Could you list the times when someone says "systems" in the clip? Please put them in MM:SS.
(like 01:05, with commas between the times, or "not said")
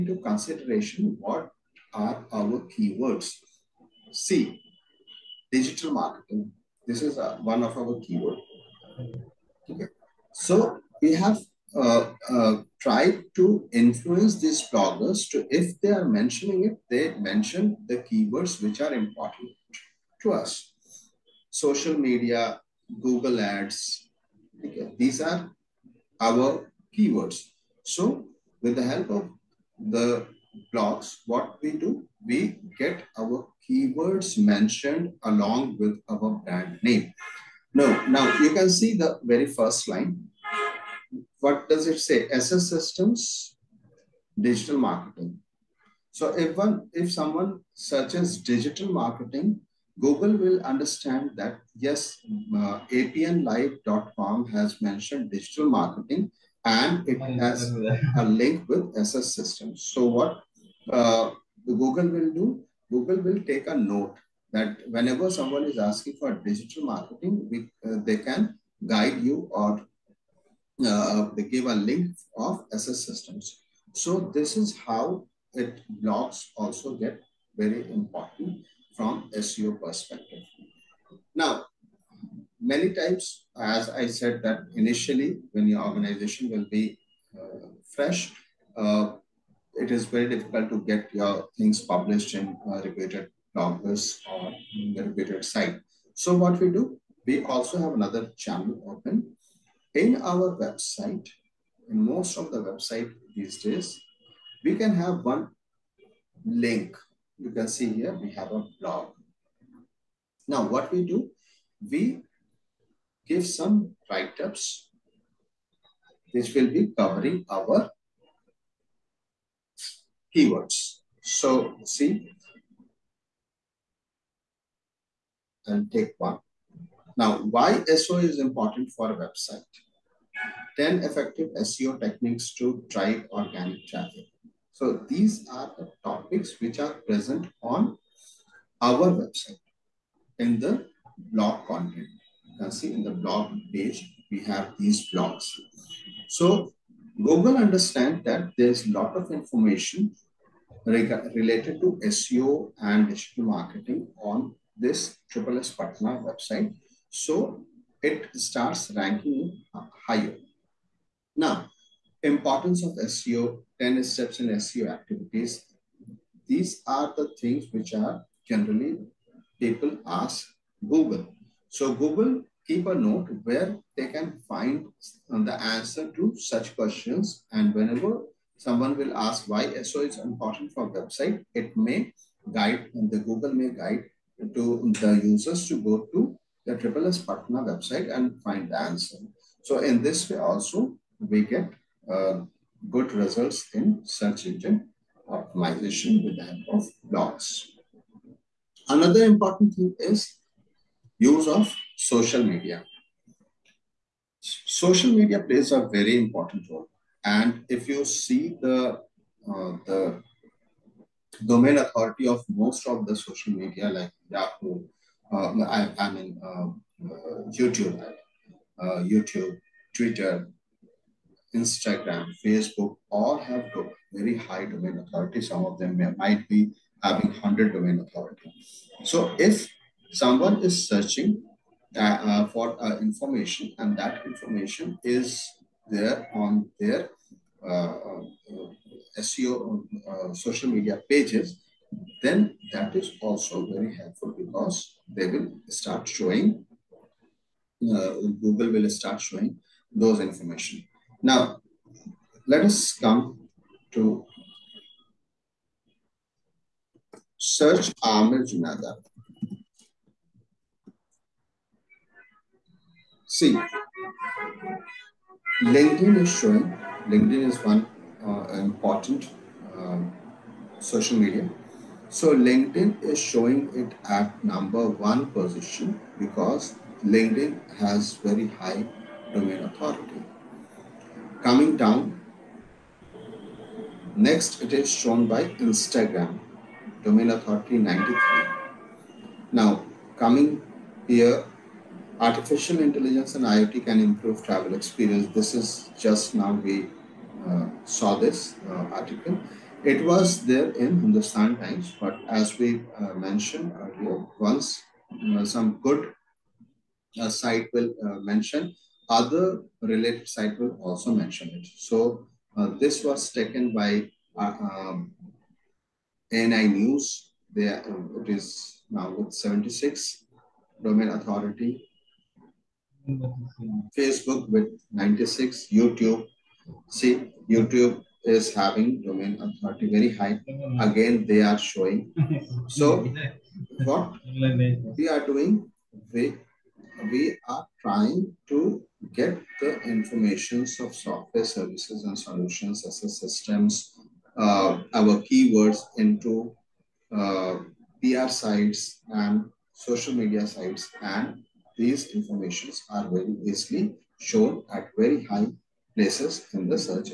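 00:42, 00:59, 01:13, 05:43.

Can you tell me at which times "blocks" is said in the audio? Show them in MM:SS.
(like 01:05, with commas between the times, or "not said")
00:30, 02:25.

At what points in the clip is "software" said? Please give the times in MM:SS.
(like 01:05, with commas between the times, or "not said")
05:40.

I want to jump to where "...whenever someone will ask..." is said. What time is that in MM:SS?
02:57.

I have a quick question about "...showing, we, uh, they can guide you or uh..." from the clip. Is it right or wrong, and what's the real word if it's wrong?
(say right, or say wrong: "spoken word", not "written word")
wrong: "marketing", not "showing".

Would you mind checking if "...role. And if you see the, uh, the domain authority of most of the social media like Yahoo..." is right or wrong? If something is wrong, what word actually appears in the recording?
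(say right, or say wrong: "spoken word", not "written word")
right.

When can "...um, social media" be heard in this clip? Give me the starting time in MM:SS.
04:29.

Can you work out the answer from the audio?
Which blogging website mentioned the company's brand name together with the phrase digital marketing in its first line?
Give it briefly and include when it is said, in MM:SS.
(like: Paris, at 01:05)
apnlive.com, at 00:52.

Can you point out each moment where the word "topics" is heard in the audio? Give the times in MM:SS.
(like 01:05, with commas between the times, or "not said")
02:16.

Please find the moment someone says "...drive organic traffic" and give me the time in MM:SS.
02:12.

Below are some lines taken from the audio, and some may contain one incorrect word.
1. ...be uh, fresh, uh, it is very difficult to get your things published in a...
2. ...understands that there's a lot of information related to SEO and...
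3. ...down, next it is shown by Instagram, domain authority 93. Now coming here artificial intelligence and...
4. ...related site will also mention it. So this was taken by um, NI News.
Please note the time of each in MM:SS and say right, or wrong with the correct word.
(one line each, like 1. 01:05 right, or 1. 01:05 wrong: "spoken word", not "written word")
1. 01:26 right
2. 02:27 right
3. 04:41 right
4. 05:09 right.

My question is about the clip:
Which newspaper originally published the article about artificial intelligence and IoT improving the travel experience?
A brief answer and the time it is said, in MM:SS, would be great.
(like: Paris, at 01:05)
Hindustan Times, at 05:00.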